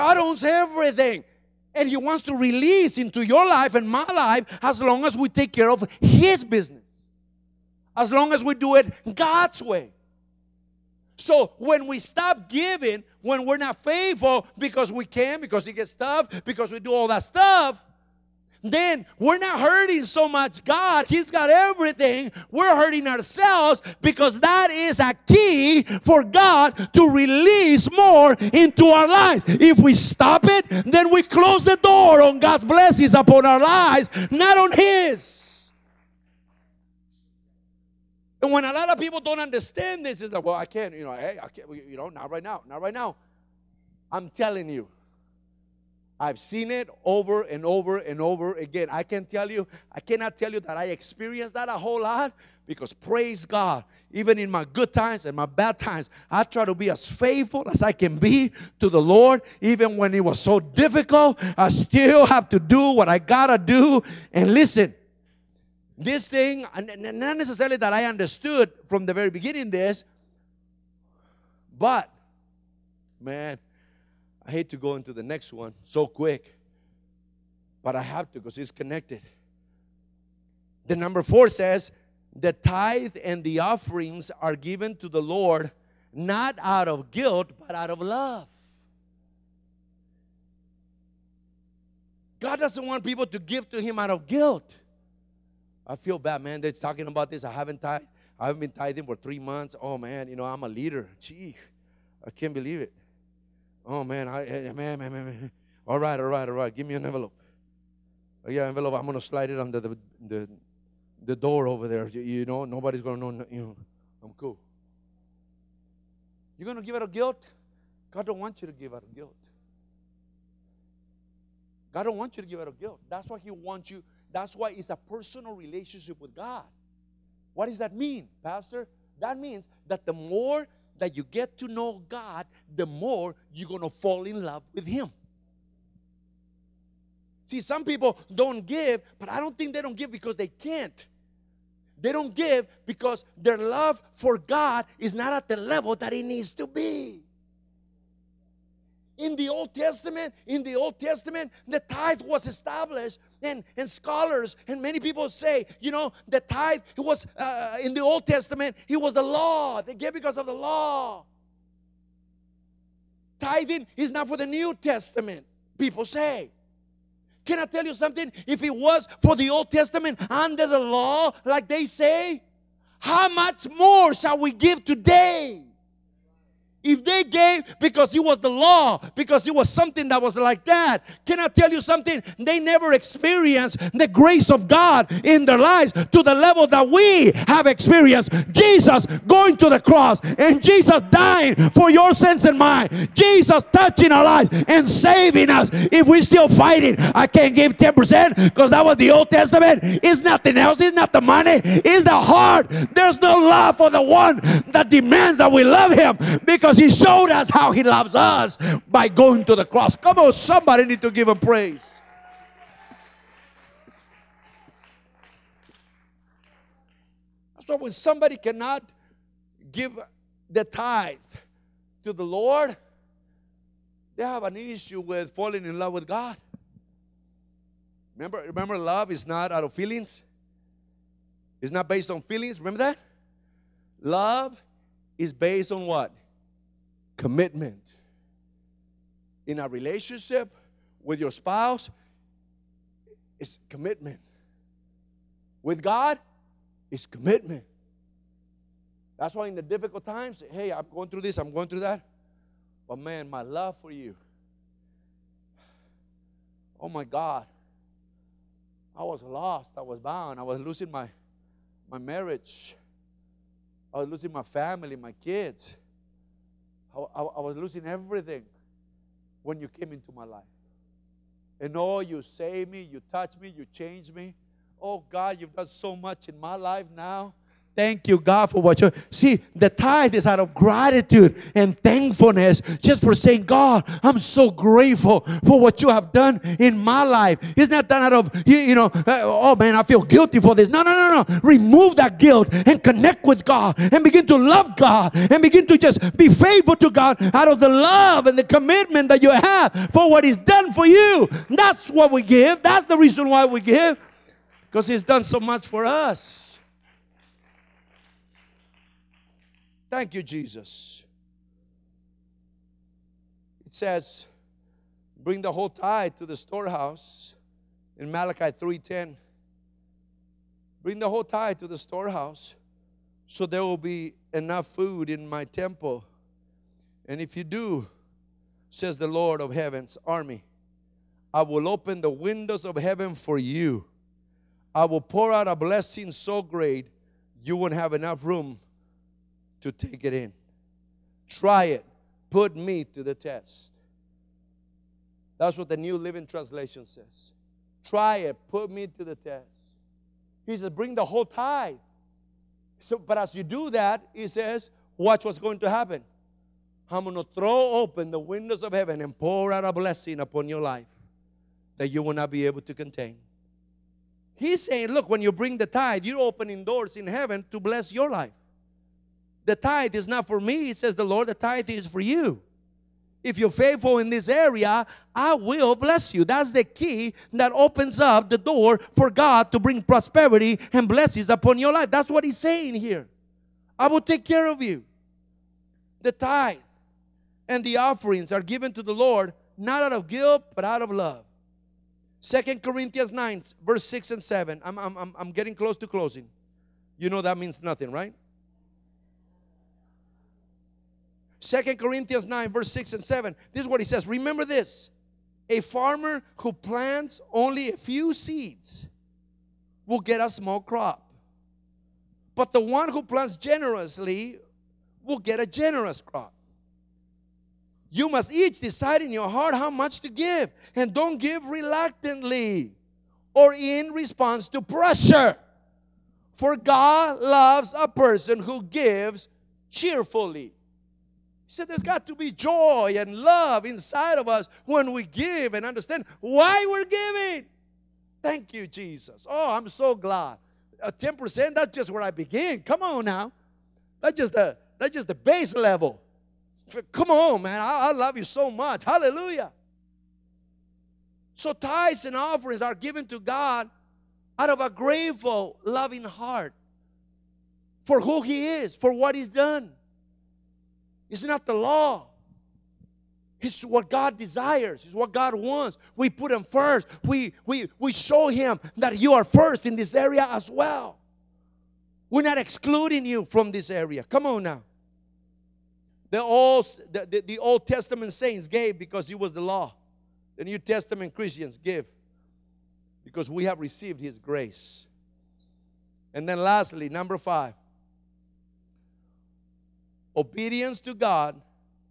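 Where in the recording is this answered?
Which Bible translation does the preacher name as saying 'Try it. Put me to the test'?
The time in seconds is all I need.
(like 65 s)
345 s.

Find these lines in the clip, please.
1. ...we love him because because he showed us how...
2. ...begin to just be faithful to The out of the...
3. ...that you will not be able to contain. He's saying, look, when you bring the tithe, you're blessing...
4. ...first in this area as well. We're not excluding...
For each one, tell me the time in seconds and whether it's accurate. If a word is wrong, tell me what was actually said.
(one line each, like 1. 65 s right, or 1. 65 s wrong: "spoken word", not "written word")
1. 205 s right
2. 295 s wrong: "God", not "The"
3. 361 s wrong: "opening", not "blessing"
4. 469 s right.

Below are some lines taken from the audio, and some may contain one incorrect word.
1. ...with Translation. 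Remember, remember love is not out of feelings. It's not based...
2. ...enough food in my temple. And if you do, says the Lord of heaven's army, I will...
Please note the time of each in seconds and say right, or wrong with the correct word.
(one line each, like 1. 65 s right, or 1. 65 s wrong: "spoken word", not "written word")
1. 225 s wrong: "God", not "Translation"
2. 324 s right.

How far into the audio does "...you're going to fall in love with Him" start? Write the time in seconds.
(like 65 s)
133 s.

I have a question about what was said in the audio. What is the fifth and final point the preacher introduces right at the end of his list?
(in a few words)
Obedience to God.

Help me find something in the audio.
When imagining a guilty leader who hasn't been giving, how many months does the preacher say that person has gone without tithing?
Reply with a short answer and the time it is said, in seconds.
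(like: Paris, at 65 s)
3, at 99 s.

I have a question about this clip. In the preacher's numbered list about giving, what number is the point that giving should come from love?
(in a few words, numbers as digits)
4.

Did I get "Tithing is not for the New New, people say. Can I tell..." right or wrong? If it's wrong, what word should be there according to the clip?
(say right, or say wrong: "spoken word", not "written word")
wrong: "Testament", not "New".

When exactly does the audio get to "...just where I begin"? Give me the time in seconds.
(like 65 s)
441 s.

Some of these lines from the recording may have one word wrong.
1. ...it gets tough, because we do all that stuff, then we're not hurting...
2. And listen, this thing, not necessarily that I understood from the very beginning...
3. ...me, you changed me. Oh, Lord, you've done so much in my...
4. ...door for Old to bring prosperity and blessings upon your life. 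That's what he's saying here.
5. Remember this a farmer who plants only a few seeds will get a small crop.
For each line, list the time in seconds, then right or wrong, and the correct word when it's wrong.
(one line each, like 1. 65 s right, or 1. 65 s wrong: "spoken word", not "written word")
1. 15 s right
2. 64 s right
3. 273 s wrong: "God", not "Lord"
4. 378 s wrong: "God", not "Old"
5. 404 s right.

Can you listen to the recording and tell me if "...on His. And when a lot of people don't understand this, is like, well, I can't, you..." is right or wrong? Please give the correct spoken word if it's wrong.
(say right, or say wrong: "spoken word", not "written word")
right.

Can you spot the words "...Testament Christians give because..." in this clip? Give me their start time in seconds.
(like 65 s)
480 s.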